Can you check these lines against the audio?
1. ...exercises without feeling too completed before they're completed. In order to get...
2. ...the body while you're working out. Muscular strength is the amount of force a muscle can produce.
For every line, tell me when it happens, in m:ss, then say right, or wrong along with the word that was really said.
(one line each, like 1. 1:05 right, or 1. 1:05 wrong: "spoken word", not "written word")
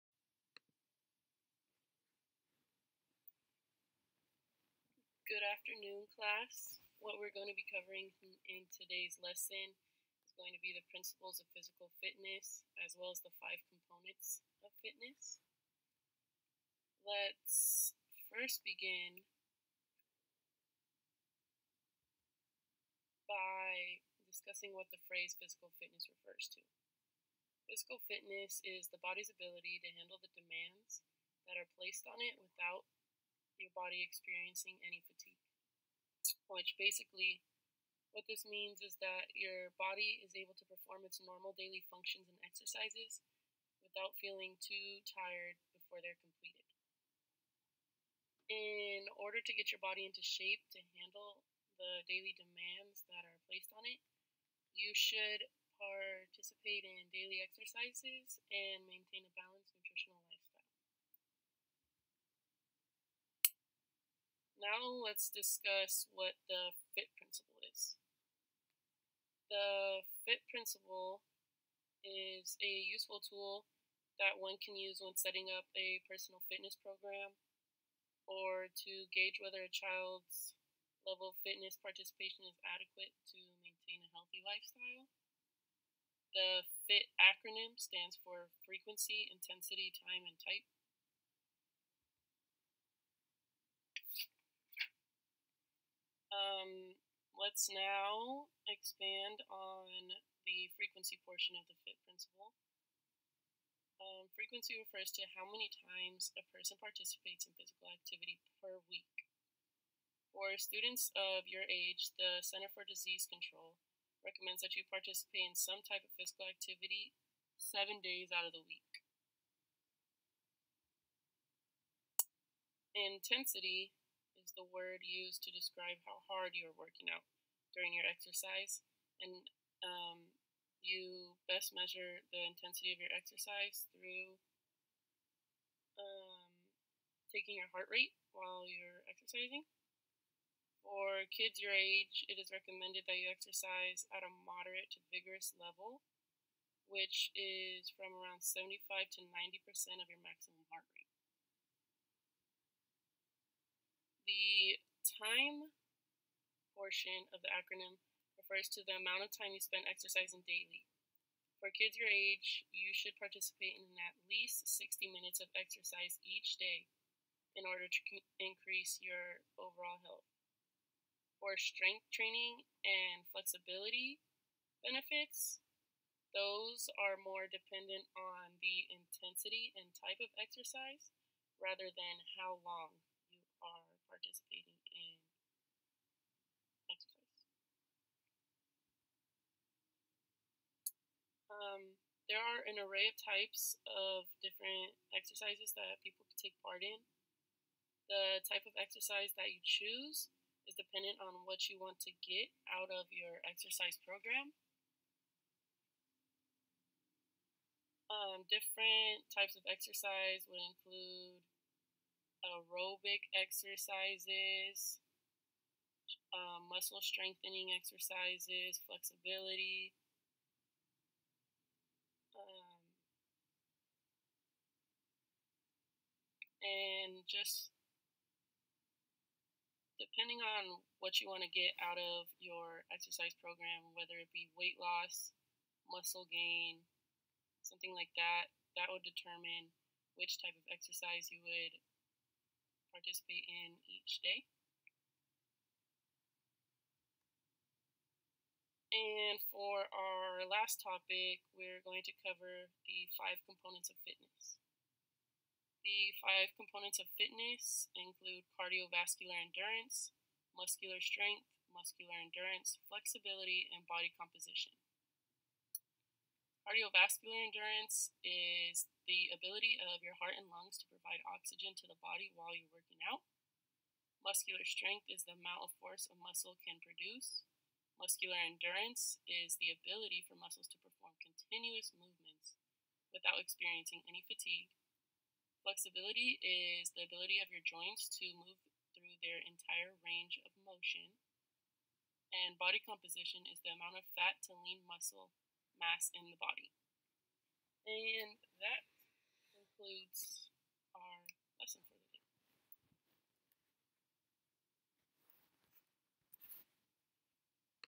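1. 0:42 wrong: "tired", not "completed"
2. 4:31 right.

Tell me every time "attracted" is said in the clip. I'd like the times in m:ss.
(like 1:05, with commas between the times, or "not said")
not said.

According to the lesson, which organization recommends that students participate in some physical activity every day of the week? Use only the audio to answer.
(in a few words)
Center for Disease Control.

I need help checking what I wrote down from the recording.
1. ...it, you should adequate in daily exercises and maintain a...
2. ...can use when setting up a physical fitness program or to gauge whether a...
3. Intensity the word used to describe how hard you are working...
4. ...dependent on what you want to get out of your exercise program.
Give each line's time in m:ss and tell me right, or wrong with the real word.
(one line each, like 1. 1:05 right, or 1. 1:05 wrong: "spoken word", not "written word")
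1. 0:53 wrong: "participate", not "adequate"
2. 1:14 wrong: "personal", not "physical"
3. 2:02 right
4. 3:20 right.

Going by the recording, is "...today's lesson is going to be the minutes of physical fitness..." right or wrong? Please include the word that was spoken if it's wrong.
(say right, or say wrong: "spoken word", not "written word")
wrong: "principles", not "minutes".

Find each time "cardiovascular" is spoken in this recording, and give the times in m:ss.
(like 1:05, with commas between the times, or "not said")
4:18, 4:26.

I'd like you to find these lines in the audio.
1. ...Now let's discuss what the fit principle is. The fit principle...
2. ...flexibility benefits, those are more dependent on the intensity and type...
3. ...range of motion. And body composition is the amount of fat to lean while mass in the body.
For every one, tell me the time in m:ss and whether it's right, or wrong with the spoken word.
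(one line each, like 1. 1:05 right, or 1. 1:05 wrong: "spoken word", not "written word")
1. 1:04 right
2. 2:53 right
3. 4:50 wrong: "muscle", not "while".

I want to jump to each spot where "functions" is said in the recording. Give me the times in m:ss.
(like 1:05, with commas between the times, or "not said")
0:41.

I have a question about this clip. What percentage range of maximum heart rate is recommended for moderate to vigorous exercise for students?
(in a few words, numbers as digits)
75 to 90%.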